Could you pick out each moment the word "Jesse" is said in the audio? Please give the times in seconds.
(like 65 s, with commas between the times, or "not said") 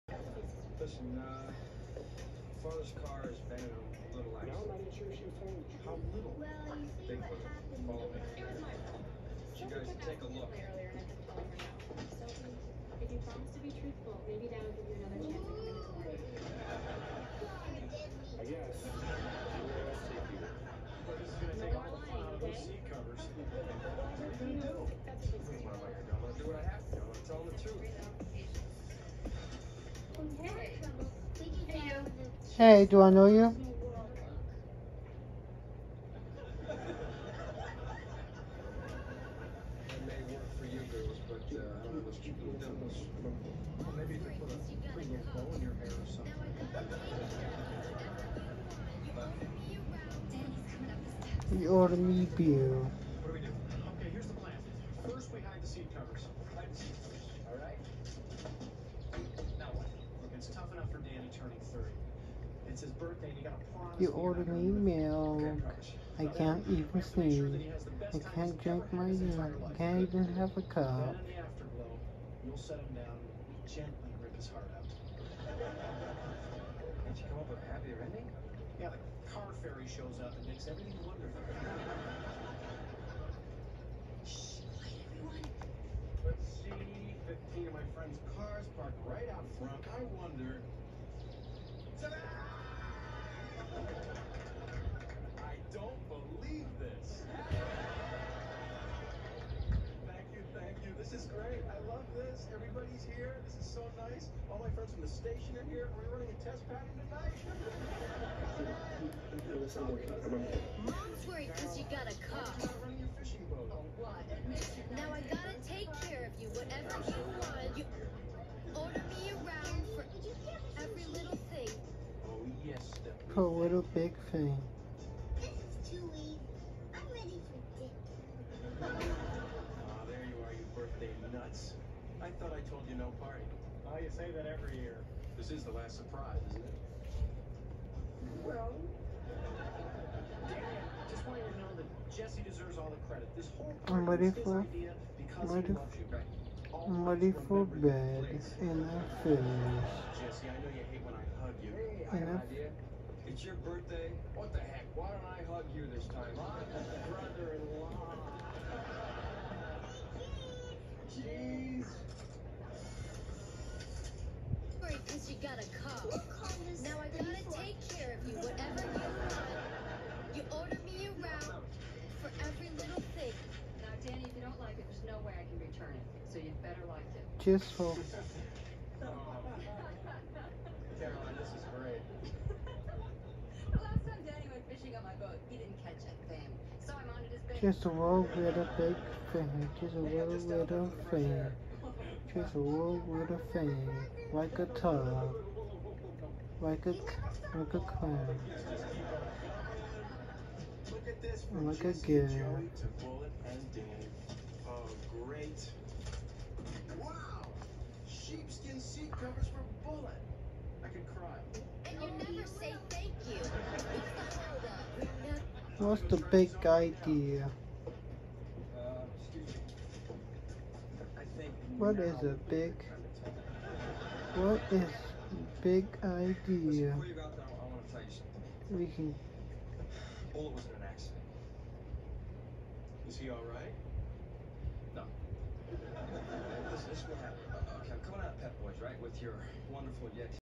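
142 s, 149 s.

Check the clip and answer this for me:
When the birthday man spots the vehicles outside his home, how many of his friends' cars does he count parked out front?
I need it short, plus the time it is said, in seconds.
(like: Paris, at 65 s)
15, at 87 s.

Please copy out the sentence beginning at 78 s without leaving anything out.
Yeah, the car fairy shows up and makes everything wonderful.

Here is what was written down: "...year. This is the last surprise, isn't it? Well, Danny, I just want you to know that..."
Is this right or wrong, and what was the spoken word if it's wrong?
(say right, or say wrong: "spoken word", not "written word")
right.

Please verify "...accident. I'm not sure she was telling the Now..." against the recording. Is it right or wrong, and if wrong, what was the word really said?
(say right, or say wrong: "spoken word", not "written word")
wrong: "How", not "Now".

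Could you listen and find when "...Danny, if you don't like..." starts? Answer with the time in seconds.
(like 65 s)
174 s.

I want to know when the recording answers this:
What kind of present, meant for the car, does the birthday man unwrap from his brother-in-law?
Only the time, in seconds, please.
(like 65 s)
208 s.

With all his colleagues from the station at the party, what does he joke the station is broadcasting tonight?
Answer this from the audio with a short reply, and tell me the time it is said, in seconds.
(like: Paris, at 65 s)
A test pattern, at 106 s.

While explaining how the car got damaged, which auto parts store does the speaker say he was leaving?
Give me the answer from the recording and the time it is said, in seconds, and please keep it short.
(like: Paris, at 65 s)
Pep Boys, at 238 s.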